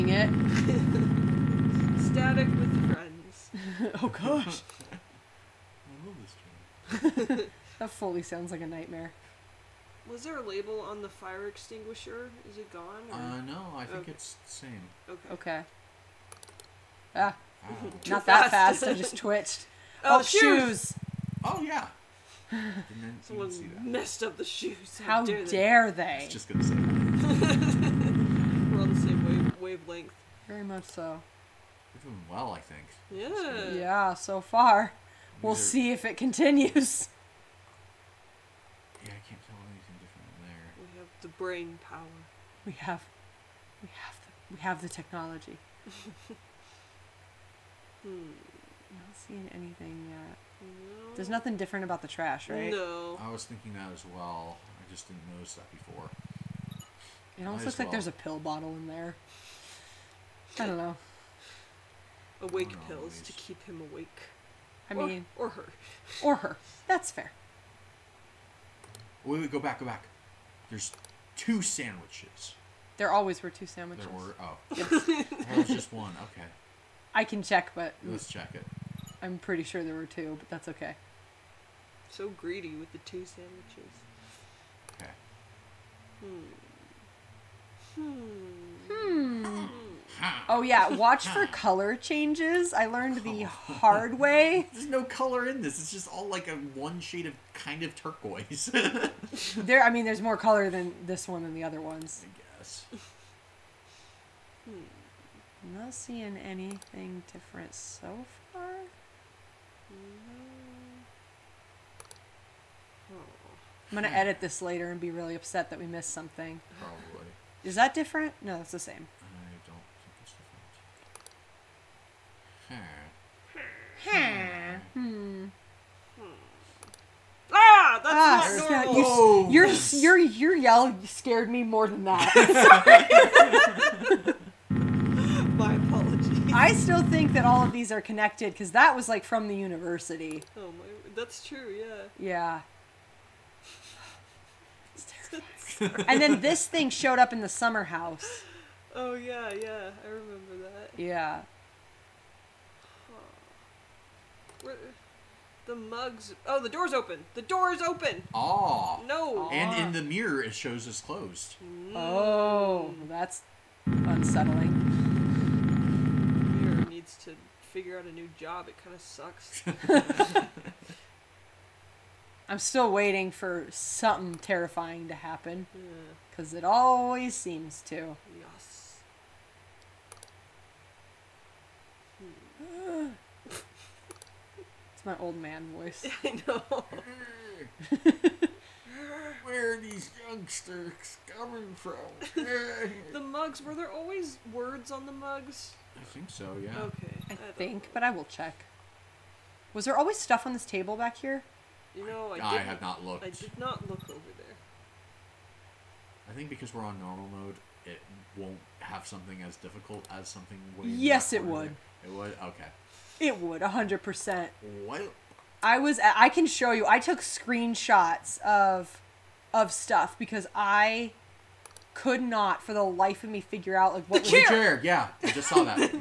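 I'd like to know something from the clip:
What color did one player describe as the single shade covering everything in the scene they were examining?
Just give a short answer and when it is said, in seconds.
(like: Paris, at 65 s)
turquoise, at 97 s.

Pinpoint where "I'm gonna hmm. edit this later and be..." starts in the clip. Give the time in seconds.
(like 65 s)
113 s.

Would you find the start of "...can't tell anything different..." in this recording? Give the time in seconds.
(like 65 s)
39 s.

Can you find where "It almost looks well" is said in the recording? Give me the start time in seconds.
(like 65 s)
57 s.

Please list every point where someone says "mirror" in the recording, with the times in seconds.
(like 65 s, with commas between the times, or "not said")
160 s, 166 s.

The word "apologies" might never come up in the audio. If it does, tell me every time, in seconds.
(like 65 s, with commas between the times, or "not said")
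135 s.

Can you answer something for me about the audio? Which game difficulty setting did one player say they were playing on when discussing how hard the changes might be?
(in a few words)
normal mode.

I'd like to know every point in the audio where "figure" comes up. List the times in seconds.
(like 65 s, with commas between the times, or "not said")
167 s, 223 s.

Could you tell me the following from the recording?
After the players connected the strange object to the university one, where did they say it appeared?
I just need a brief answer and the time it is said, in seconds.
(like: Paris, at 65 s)
the summer house, at 147 s.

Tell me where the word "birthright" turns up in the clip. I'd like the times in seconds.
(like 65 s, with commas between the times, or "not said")
not said.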